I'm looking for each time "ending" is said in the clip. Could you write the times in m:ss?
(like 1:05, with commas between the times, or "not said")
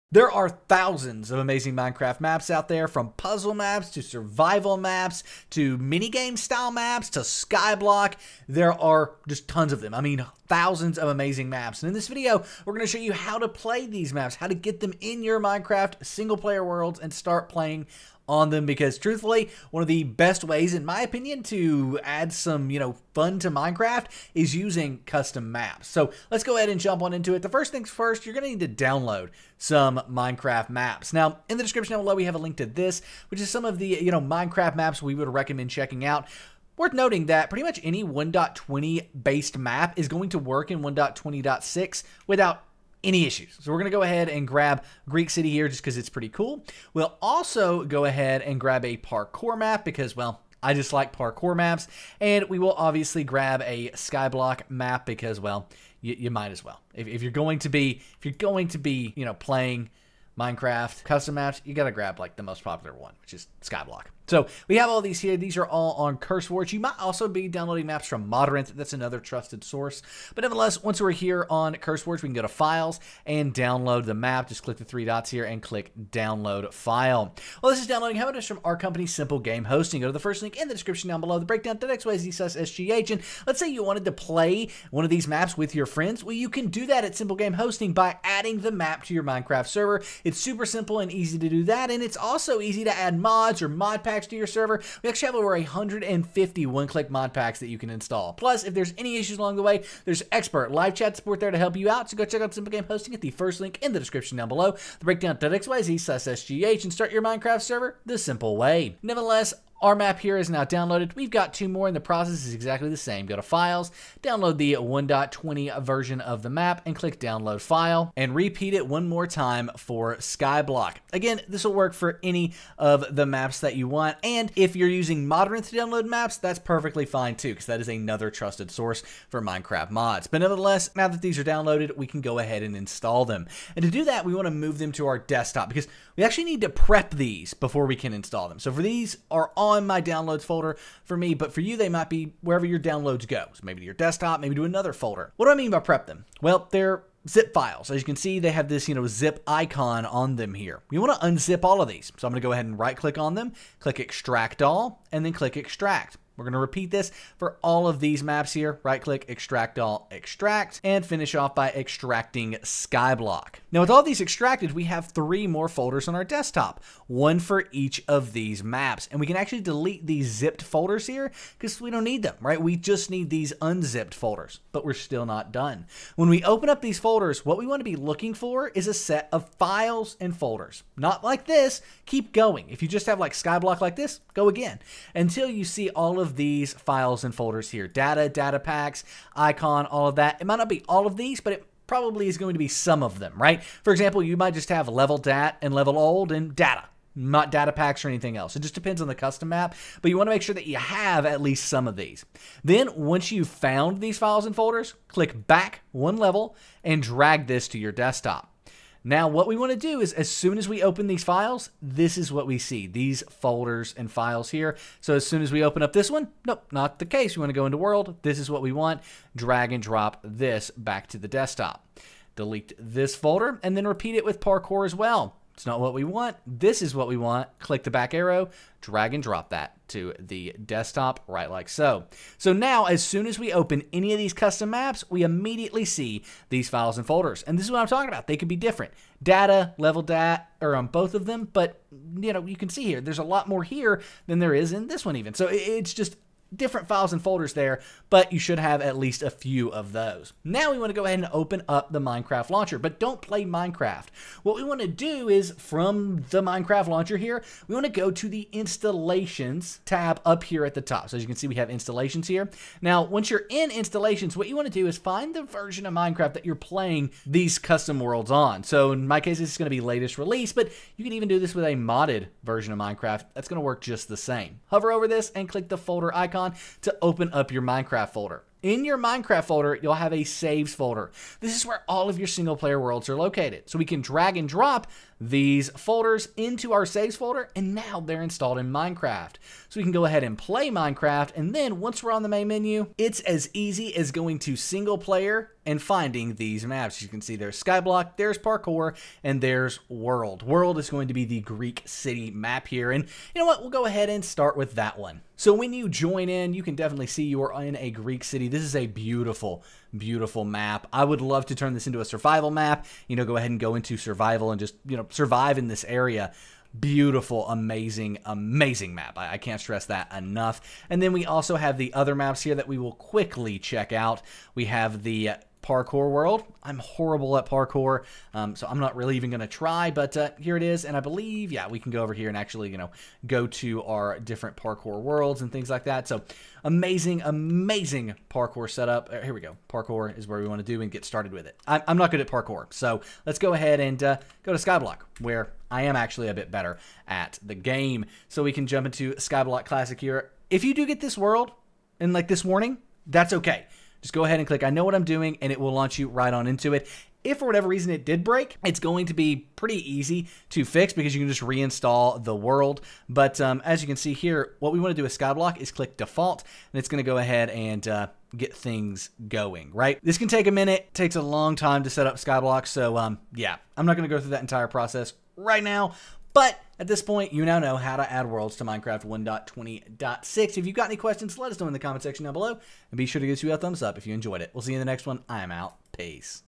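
not said.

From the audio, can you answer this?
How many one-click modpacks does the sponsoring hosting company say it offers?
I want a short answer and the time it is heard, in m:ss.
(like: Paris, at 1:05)
over 150, at 1:35.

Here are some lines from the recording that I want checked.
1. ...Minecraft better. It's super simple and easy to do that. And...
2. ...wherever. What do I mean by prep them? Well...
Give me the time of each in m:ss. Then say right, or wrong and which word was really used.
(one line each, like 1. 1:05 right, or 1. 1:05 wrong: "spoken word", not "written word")
1. 1:29 wrong: "server", not "better"
2. 2:24 wrong: "folder", not "wherever".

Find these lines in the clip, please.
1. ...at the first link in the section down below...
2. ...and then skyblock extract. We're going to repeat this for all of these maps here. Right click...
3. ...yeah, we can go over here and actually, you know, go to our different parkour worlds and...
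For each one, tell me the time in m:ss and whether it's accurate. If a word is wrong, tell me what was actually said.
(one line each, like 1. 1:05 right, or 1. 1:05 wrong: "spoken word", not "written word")
1. 1:43 wrong: "description", not "section"
2. 2:35 wrong: "click", not "skyblock"
3. 5:31 right.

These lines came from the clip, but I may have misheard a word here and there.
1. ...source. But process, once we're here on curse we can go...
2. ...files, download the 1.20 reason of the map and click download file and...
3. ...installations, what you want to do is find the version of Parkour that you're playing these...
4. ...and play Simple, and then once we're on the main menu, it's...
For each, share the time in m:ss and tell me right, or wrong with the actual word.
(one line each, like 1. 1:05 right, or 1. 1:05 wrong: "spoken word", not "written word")
1. 1:09 wrong: "nevertheless", not "process"
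2. 1:53 wrong: "version", not "reason"
3. 4:23 wrong: "Minecraft", not "Parkour"
4. 4:50 wrong: "Minecraft", not "Simple".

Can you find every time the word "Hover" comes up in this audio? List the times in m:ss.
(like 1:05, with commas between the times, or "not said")
4:34.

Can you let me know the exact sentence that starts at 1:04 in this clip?
So we have all these here.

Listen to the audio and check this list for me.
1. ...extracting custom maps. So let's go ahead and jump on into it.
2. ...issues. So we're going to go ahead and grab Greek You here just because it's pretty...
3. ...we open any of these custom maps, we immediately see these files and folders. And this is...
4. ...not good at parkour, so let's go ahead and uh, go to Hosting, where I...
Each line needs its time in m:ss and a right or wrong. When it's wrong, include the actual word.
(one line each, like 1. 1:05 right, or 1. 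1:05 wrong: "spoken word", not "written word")
1. 0:24 wrong: "using", not "extracting"
2. 0:43 wrong: "City", not "You"
3. 3:53 right
4. 5:41 wrong: "Skyblock", not "Hosting".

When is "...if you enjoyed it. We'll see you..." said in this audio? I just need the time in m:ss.
6:23.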